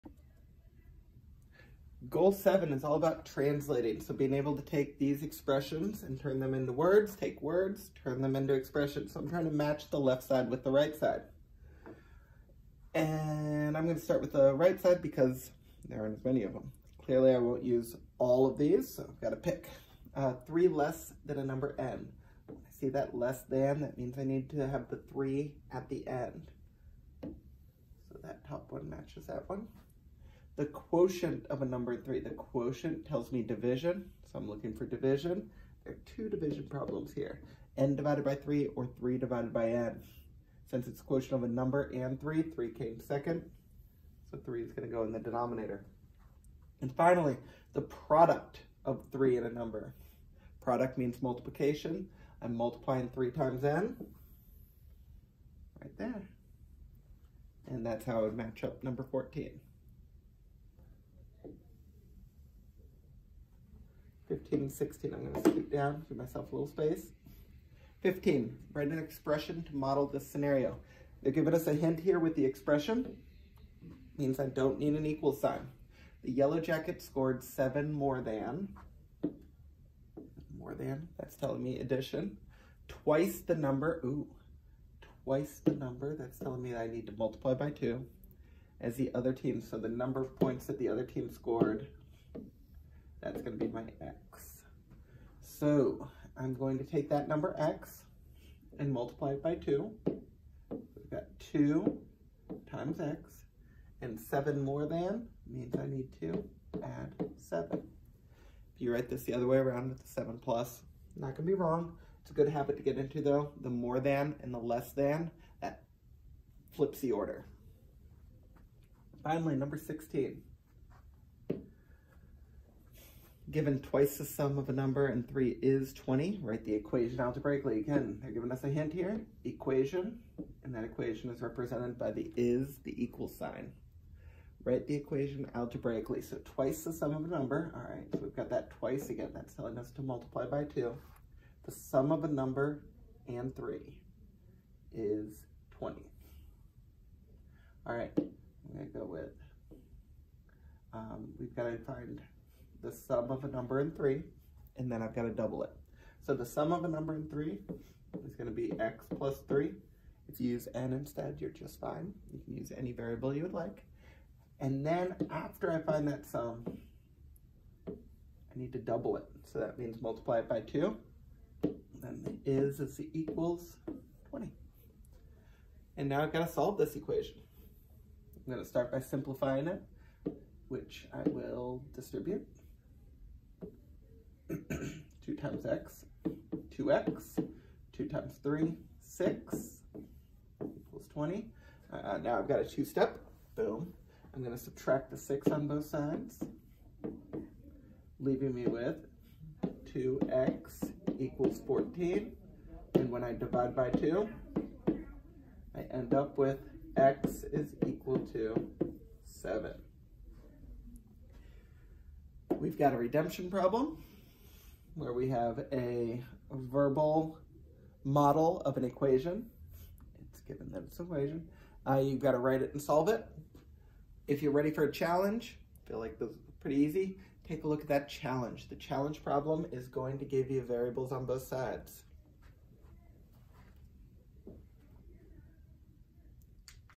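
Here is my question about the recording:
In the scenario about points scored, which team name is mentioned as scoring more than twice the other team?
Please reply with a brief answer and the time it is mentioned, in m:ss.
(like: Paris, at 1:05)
Yellow jacket, at 1:16.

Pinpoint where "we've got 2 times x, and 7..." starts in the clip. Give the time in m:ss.
1:40.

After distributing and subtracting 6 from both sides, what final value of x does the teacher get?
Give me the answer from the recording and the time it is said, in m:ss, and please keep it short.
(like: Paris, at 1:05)
7, at 3:26.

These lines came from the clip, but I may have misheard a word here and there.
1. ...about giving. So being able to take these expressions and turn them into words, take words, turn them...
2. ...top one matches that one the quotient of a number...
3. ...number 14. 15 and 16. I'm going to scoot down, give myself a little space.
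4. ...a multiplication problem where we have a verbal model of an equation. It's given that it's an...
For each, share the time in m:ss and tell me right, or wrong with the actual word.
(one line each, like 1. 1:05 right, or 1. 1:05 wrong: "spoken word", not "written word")
1. 0:02 wrong: "translating", not "giving"
2. 0:28 right
3. 0:58 right
4. 3:32 wrong: "redemption", not "multiplication".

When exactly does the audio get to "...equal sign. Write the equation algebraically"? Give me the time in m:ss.
2:13.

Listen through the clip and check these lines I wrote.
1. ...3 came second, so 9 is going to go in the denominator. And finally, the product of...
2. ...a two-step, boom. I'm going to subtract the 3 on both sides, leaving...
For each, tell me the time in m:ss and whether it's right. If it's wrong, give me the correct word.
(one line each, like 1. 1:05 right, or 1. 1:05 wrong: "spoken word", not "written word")
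1. 0:42 wrong: "3", not "9"
2. 3:12 wrong: "6", not "3".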